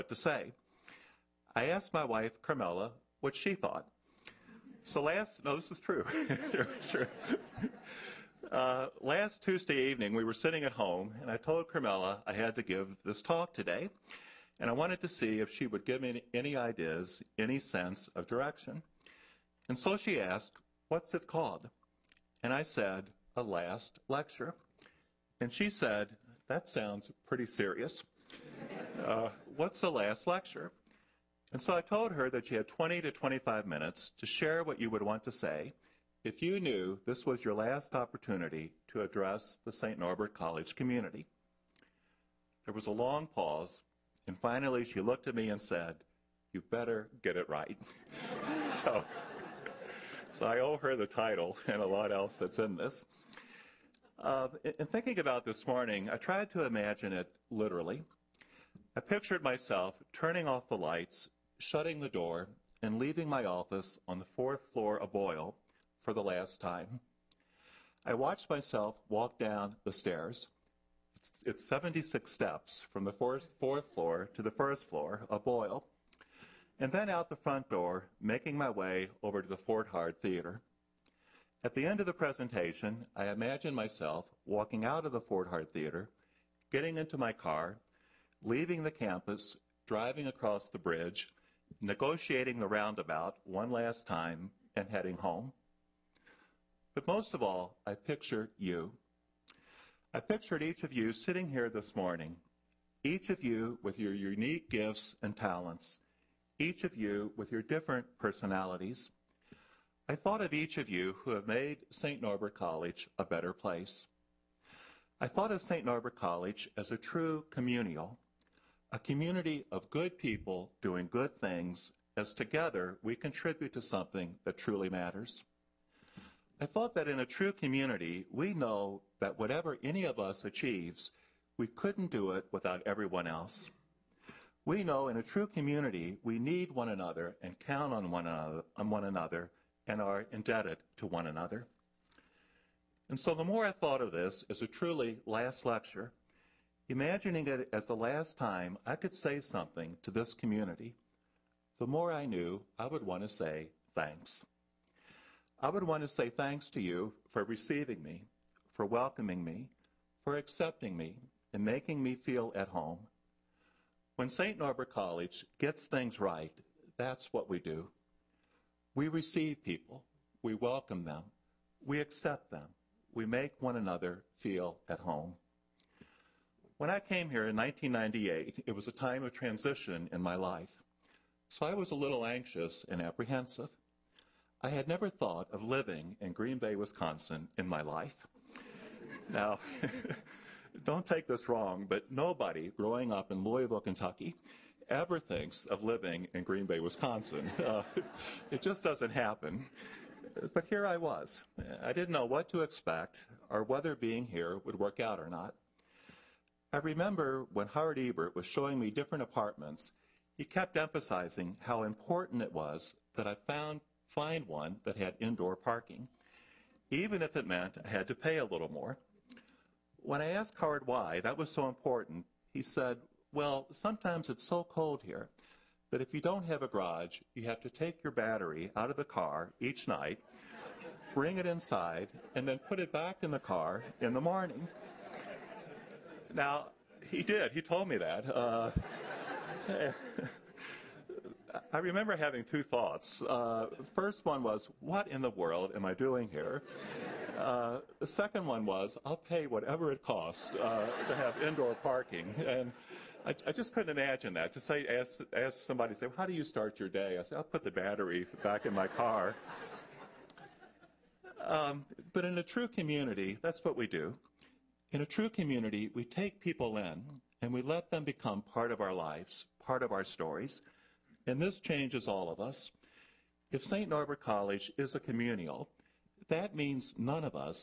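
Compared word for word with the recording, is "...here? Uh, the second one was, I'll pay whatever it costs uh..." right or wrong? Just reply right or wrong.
right.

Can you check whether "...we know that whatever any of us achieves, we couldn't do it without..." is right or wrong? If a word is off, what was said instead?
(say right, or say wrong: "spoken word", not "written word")
right.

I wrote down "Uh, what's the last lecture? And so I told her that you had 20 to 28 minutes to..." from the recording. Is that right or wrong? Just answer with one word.
wrong.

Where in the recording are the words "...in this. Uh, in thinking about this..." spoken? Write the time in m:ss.
0:52.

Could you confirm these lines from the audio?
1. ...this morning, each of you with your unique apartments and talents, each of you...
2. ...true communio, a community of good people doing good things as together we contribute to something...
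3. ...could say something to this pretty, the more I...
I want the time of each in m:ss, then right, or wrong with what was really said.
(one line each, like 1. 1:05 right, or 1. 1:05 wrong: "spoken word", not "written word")
1. 1:41 wrong: "gifts", not "apartments"
2. 1:56 right
3. 2:28 wrong: "community", not "pretty".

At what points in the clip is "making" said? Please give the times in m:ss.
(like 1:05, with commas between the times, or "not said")
1:18, 2:41.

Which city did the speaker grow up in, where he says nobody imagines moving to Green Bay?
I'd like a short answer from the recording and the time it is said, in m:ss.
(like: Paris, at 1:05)
Louisville, Kentucky, at 3:13.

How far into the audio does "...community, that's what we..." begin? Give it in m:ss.
4:22.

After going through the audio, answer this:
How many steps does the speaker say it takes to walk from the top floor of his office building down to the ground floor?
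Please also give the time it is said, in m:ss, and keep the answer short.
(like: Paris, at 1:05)
76, at 1:11.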